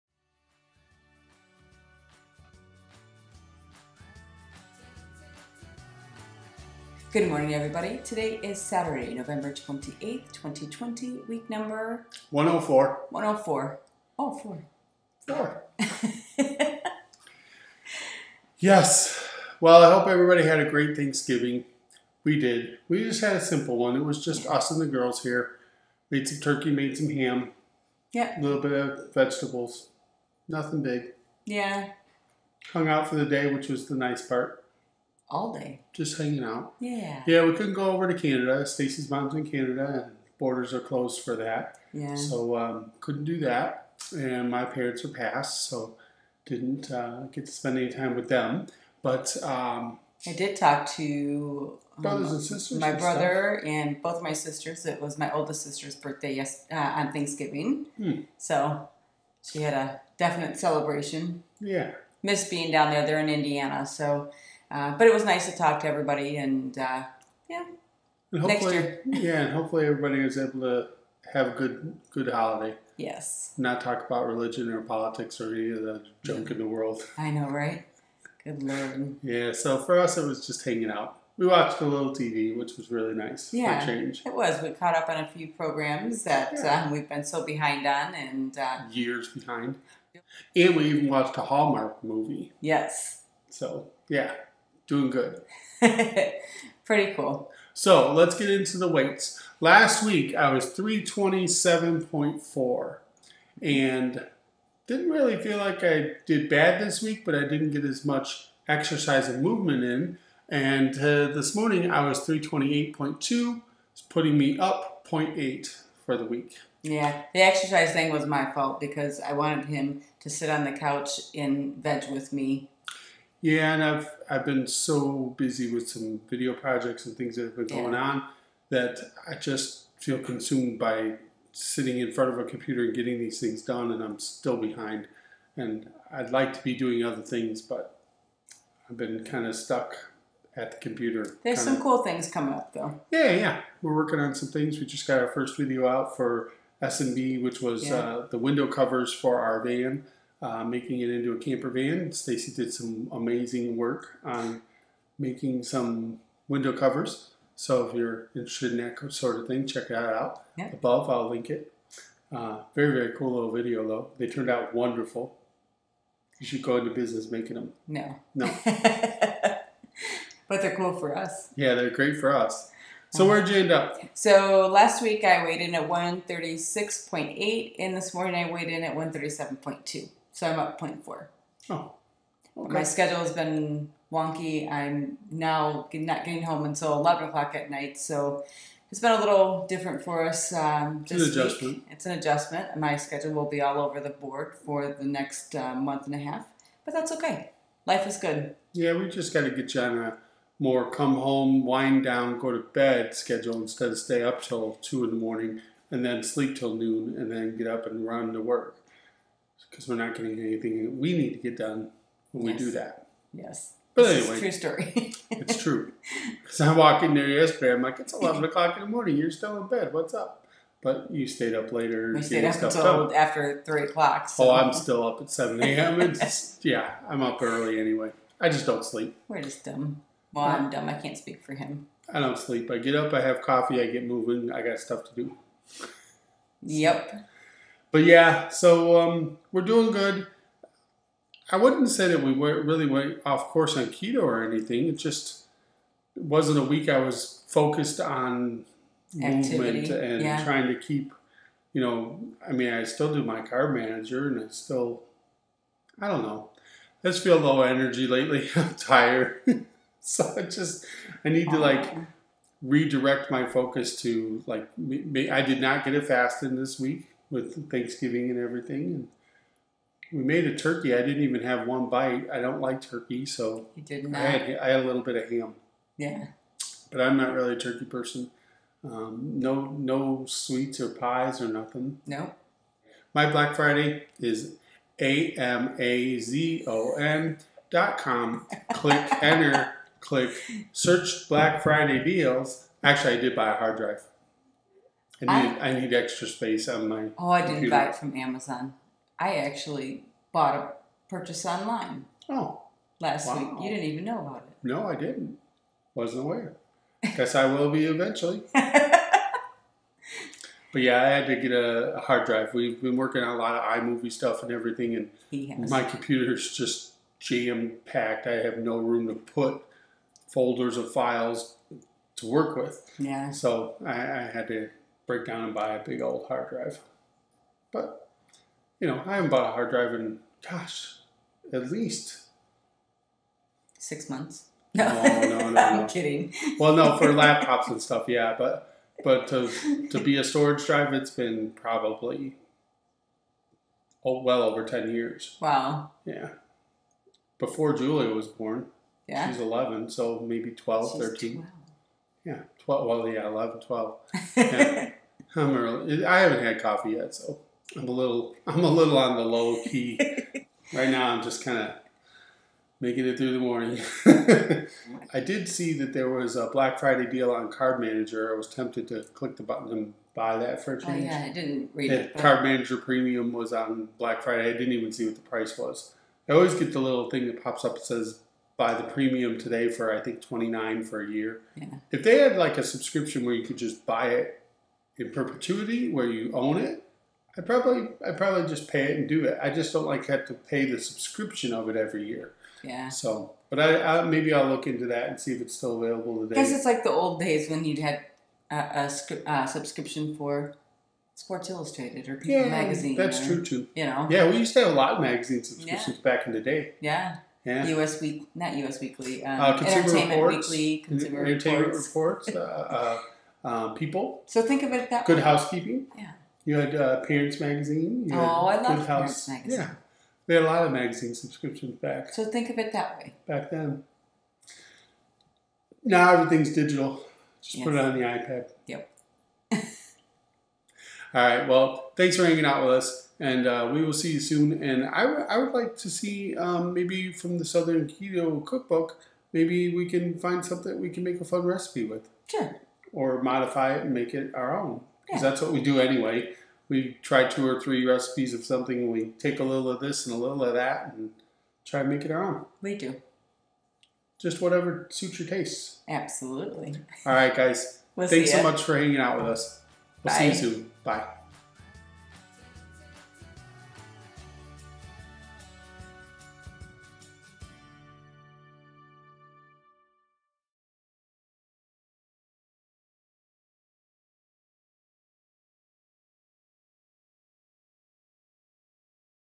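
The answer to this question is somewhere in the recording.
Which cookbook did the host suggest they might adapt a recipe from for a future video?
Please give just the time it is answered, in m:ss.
7:17.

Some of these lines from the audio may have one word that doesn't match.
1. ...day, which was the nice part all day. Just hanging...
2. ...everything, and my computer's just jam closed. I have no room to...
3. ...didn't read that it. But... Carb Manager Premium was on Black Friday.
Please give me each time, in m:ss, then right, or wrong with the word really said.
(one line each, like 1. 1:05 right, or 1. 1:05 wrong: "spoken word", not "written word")
1. 0:33 right
2. 5:14 wrong: "packed", not "closed"
3. 6:11 right.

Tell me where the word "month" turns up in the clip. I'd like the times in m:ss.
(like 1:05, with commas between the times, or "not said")
3:15, 5:34.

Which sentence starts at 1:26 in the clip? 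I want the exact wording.
um, we've been so behind on, and uh, years behind.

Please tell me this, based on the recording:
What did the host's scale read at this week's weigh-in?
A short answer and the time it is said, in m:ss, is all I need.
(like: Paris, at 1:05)
328.2, at 1:52.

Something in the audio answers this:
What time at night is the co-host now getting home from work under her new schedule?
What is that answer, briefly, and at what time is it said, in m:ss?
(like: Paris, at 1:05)
11 o'clock, at 3:06.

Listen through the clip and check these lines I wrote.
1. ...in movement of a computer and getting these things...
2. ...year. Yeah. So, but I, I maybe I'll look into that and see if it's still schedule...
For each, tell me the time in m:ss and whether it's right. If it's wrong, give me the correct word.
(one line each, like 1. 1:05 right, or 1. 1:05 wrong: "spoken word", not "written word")
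1. 2:11 wrong: "front", not "movement"
2. 6:32 wrong: "available", not "schedule".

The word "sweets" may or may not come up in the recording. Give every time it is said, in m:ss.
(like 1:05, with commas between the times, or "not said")
4:40.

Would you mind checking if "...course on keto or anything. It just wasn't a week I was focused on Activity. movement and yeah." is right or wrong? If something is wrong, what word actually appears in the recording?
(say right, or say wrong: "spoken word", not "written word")
right.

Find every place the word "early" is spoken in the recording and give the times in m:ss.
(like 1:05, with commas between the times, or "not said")
3:47, 5:55.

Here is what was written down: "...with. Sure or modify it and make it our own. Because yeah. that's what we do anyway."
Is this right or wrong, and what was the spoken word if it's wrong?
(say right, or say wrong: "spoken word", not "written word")
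right.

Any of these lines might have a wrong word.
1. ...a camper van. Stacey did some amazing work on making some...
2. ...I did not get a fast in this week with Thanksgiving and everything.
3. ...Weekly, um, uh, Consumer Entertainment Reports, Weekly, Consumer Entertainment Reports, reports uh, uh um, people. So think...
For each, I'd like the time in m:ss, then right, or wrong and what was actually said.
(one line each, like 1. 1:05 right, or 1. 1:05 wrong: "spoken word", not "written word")
1. 2:31 right
2. 4:25 right
3. 6:48 right.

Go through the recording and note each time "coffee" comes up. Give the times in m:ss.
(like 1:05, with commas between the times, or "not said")
3:53, 5:56.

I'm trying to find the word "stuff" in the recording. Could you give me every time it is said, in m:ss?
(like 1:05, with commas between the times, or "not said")
0:53, 3:54, 5:14, 5:37.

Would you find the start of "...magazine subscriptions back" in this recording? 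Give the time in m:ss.
7:00.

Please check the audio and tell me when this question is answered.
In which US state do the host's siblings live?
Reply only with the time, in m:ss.
1:03.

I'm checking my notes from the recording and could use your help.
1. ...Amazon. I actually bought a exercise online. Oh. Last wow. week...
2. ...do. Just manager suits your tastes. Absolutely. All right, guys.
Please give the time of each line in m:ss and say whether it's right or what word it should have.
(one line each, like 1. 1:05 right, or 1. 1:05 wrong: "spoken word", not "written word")
1. 4:58 wrong: "purchase", not "exercise"
2. 7:32 wrong: "whatever", not "manager".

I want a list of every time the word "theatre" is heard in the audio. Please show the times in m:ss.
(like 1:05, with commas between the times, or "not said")
not said.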